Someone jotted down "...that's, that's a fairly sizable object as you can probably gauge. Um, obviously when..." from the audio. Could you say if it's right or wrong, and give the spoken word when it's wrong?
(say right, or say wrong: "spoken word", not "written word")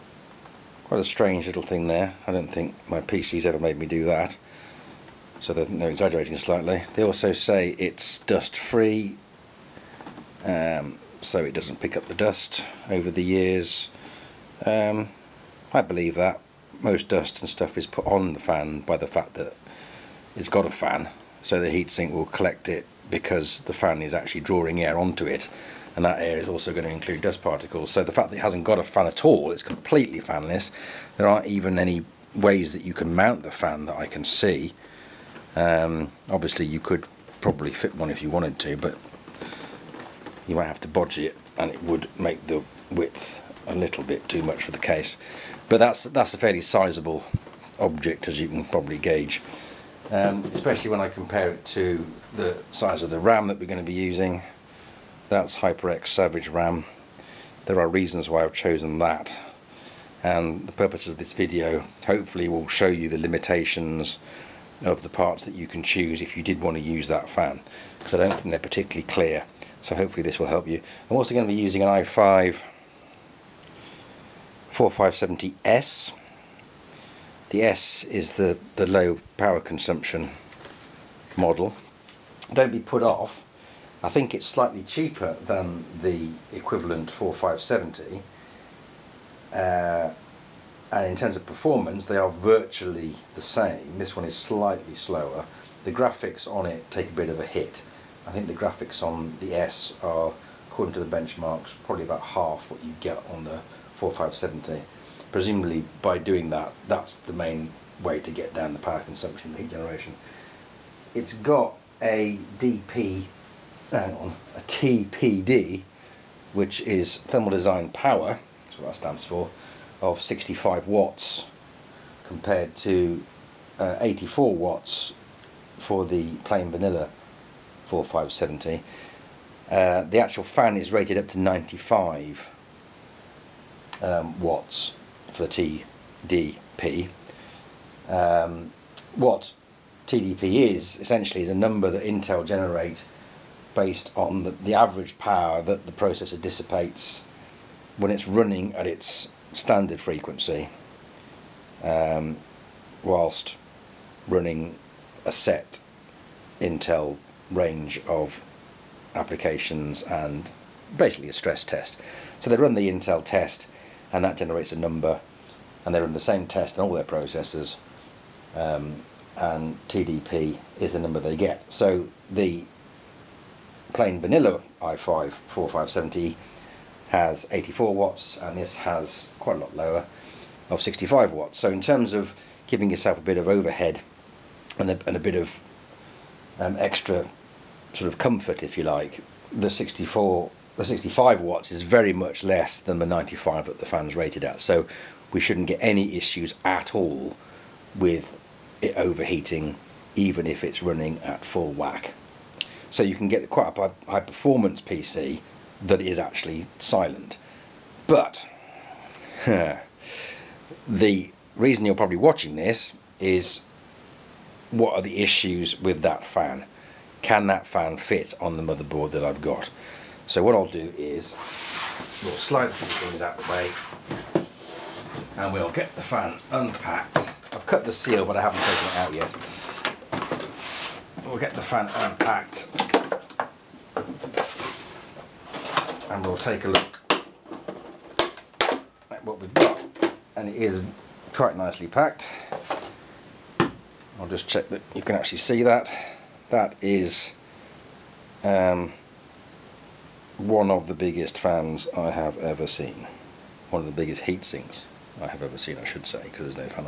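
wrong: "especially", not "obviously".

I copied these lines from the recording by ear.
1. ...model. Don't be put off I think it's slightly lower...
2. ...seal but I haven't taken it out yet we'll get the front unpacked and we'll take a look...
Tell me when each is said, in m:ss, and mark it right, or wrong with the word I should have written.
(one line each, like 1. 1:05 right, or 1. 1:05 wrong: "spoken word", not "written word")
1. 1:21 wrong: "cheaper", not "lower"
2. 3:47 right.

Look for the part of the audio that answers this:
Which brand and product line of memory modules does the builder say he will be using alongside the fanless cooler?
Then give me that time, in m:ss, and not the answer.
0:55.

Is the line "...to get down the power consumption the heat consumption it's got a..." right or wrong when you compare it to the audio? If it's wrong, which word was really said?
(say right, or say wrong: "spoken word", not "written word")
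wrong: "generation", not "consumption".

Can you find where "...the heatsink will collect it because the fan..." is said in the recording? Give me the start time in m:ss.
0:21.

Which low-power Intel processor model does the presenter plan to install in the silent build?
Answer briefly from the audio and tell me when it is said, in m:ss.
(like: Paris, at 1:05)
i5 4570S, at 1:11.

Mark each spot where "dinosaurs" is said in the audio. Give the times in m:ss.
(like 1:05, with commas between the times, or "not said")
not said.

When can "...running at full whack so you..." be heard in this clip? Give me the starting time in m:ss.
3:20.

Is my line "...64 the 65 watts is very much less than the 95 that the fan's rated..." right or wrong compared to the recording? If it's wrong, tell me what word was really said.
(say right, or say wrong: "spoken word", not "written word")
right.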